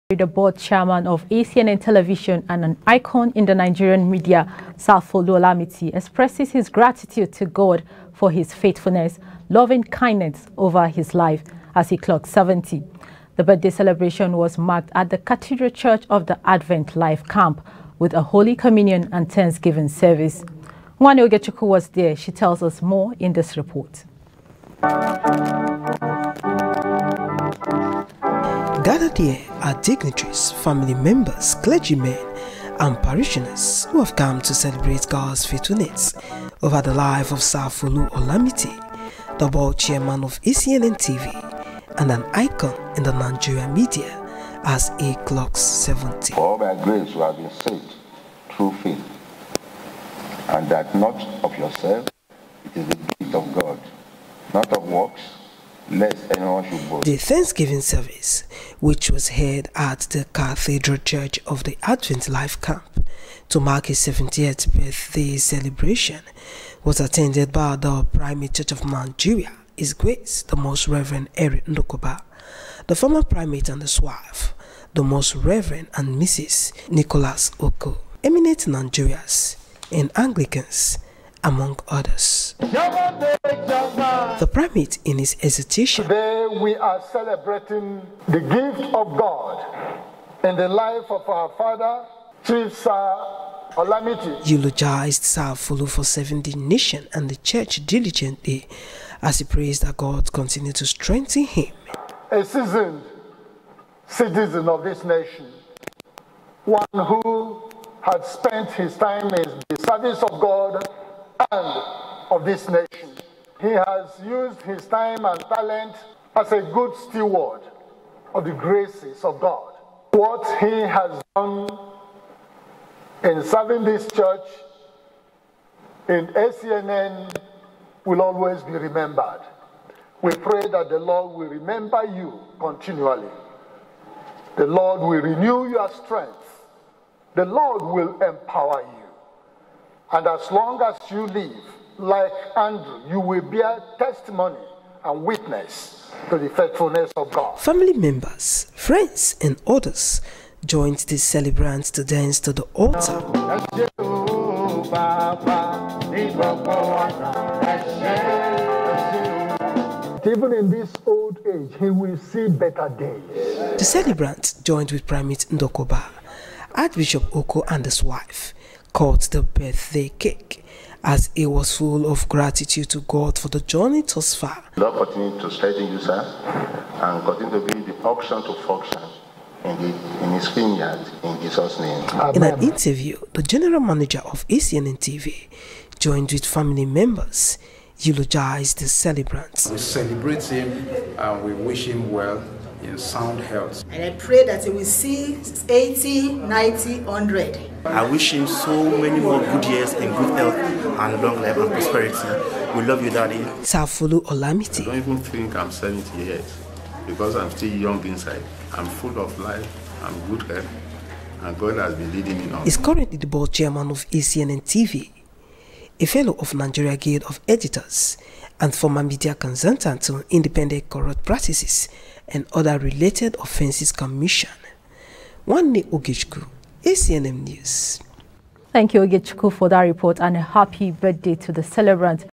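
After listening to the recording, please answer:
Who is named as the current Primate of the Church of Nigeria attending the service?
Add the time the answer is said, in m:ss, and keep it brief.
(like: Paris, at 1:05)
Eric Ndukuba, at 1:11.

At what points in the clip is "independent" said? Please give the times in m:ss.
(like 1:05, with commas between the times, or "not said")
3:40.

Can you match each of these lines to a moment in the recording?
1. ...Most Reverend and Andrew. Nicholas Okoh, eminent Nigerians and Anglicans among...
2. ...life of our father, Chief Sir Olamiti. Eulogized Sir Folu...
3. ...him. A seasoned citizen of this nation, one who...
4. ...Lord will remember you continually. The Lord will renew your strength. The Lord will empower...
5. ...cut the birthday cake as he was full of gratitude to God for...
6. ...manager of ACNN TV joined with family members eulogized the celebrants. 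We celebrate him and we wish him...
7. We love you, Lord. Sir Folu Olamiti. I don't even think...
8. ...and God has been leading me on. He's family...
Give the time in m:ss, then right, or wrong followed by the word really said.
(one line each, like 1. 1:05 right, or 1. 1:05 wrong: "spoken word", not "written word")
1. 1:15 wrong: "Mrs", not "Andrew"
2. 1:30 right
3. 1:41 right
4. 2:10 right
5. 2:48 right
6. 3:03 right
7. 3:22 wrong: "Daddy", not "Lord"
8. 3:31 wrong: "currently", not "family".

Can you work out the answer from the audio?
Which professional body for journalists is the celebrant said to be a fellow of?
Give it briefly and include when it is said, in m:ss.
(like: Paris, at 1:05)
Nigeria Guild of Editors, at 3:36.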